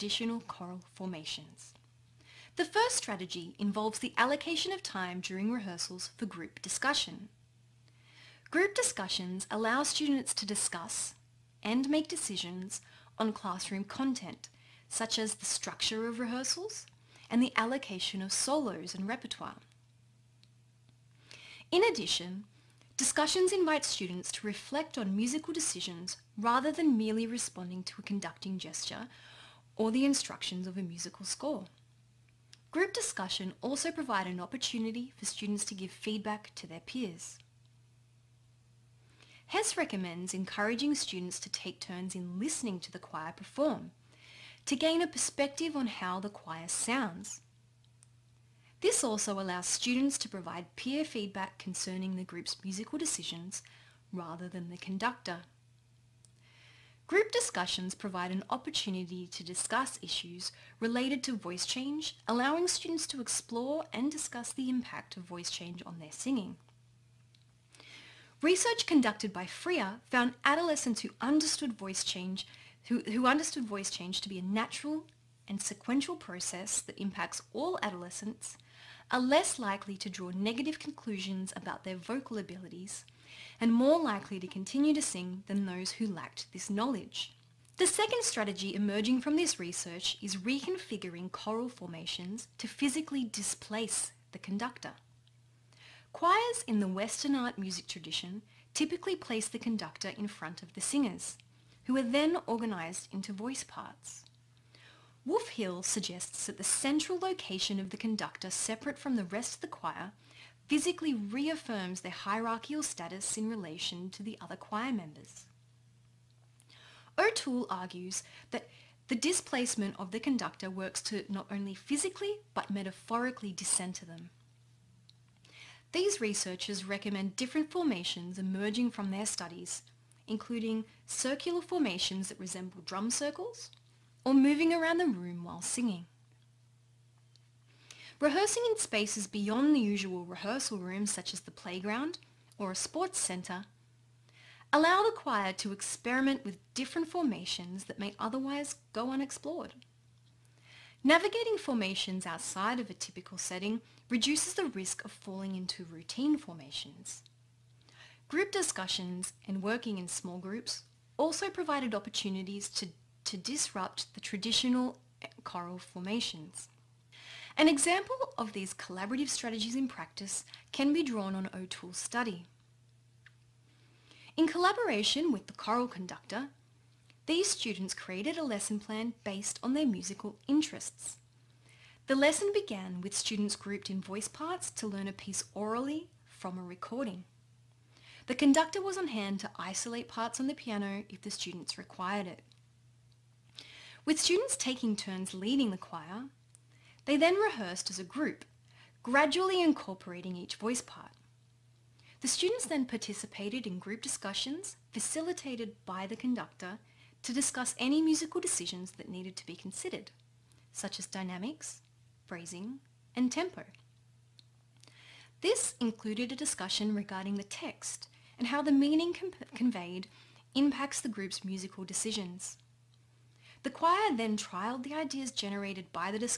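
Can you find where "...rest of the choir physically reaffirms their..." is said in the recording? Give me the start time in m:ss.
1:49.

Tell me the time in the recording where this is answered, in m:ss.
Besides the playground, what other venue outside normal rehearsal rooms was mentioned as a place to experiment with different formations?
2:22.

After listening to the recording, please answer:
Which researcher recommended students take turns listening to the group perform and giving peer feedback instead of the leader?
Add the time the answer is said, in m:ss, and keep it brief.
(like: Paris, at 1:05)
Hess, at 0:39.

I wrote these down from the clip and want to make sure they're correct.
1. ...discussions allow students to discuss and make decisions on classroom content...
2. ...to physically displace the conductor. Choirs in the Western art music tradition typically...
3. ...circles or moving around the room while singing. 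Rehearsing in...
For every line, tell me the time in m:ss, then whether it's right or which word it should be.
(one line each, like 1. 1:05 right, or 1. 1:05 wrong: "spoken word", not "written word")
1. 0:08 right
2. 1:32 right
3. 2:13 right.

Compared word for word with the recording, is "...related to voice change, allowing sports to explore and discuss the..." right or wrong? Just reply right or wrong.
wrong.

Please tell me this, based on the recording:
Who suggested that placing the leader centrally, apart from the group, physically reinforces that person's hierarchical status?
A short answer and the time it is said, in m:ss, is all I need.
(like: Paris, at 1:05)
Wolf Hill, at 1:45.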